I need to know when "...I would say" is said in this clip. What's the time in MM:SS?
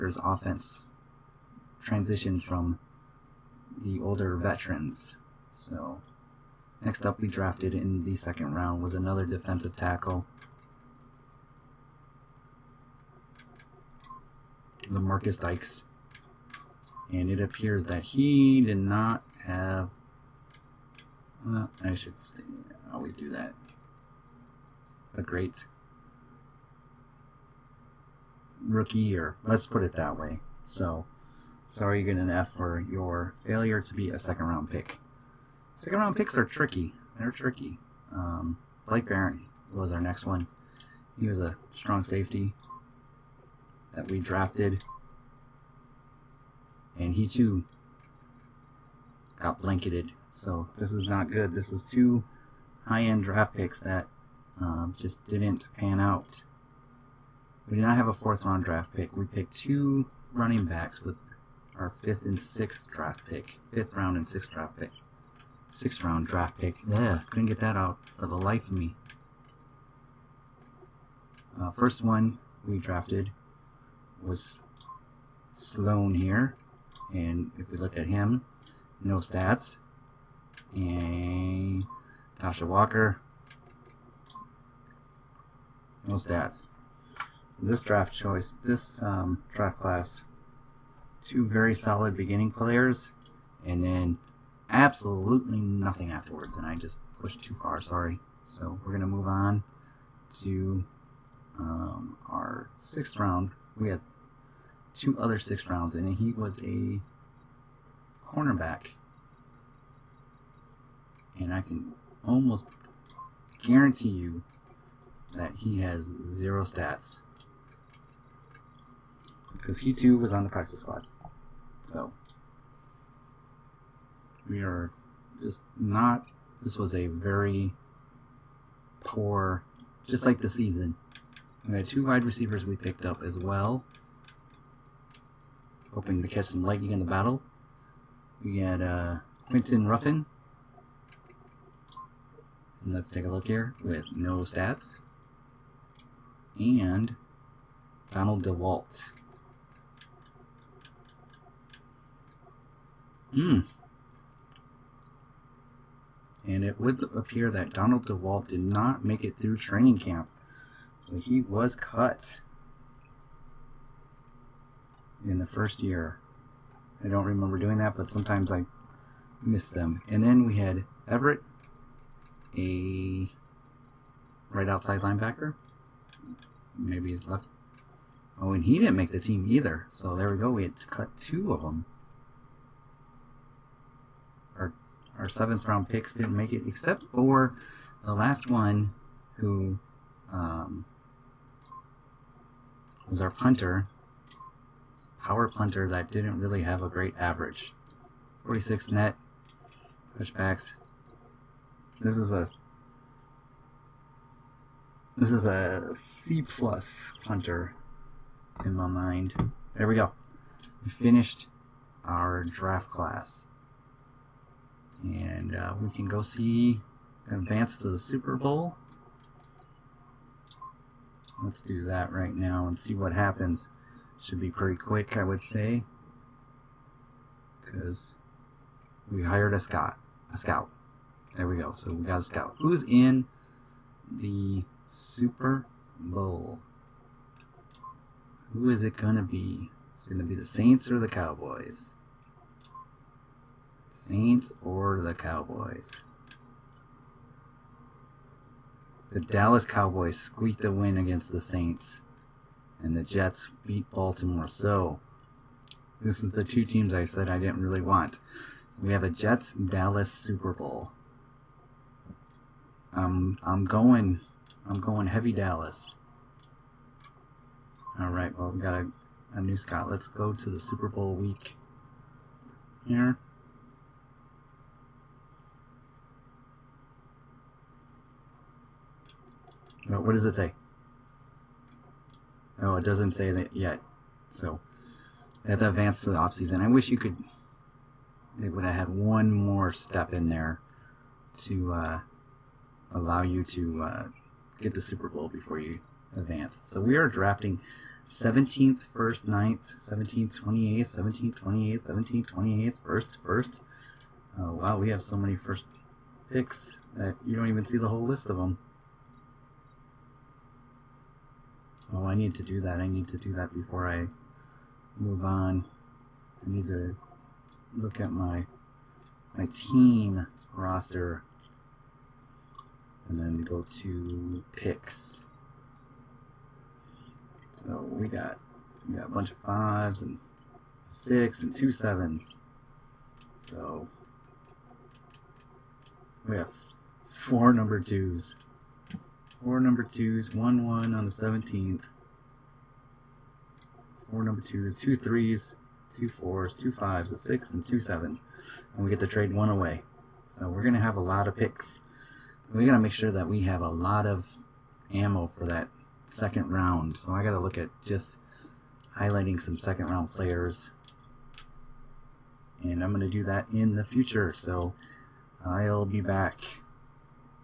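03:45.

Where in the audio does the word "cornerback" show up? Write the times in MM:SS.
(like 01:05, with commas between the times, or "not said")
01:48.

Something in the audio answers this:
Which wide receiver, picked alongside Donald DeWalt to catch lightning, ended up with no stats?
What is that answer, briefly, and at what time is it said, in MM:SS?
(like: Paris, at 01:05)
Quinton Ruffin, at 02:19.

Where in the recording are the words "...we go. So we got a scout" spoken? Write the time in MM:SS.
03:51.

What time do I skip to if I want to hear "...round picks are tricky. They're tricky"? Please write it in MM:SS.
00:35.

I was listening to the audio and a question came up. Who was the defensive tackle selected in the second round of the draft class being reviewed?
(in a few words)
Lamarcus Dykes.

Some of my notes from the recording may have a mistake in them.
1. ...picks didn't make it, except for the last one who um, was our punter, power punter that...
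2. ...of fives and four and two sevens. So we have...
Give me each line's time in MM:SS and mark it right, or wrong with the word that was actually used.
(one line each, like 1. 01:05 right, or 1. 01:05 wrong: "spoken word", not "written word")
1. 03:05 right
2. 05:29 wrong: "six", not "four".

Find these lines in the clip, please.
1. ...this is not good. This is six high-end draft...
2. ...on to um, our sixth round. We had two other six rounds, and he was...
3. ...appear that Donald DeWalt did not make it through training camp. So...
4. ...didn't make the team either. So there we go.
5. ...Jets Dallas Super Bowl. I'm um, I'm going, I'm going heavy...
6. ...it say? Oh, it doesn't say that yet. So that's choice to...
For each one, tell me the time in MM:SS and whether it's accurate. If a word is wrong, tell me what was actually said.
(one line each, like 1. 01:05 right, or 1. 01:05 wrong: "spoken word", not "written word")
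1. 00:50 wrong: "two", not "six"
2. 01:39 right
3. 02:37 right
4. 02:58 right
5. 04:19 right
6. 04:40 wrong: "advance", not "choice".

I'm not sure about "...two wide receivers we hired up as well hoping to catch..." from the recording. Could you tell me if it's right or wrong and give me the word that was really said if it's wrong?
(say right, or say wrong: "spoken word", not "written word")
wrong: "picked", not "hired".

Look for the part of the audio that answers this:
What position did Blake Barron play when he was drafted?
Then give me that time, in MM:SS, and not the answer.
00:41.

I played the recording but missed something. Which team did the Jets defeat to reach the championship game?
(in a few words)
Baltimore.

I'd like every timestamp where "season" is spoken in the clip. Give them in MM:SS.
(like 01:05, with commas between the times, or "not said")
02:10, 04:46.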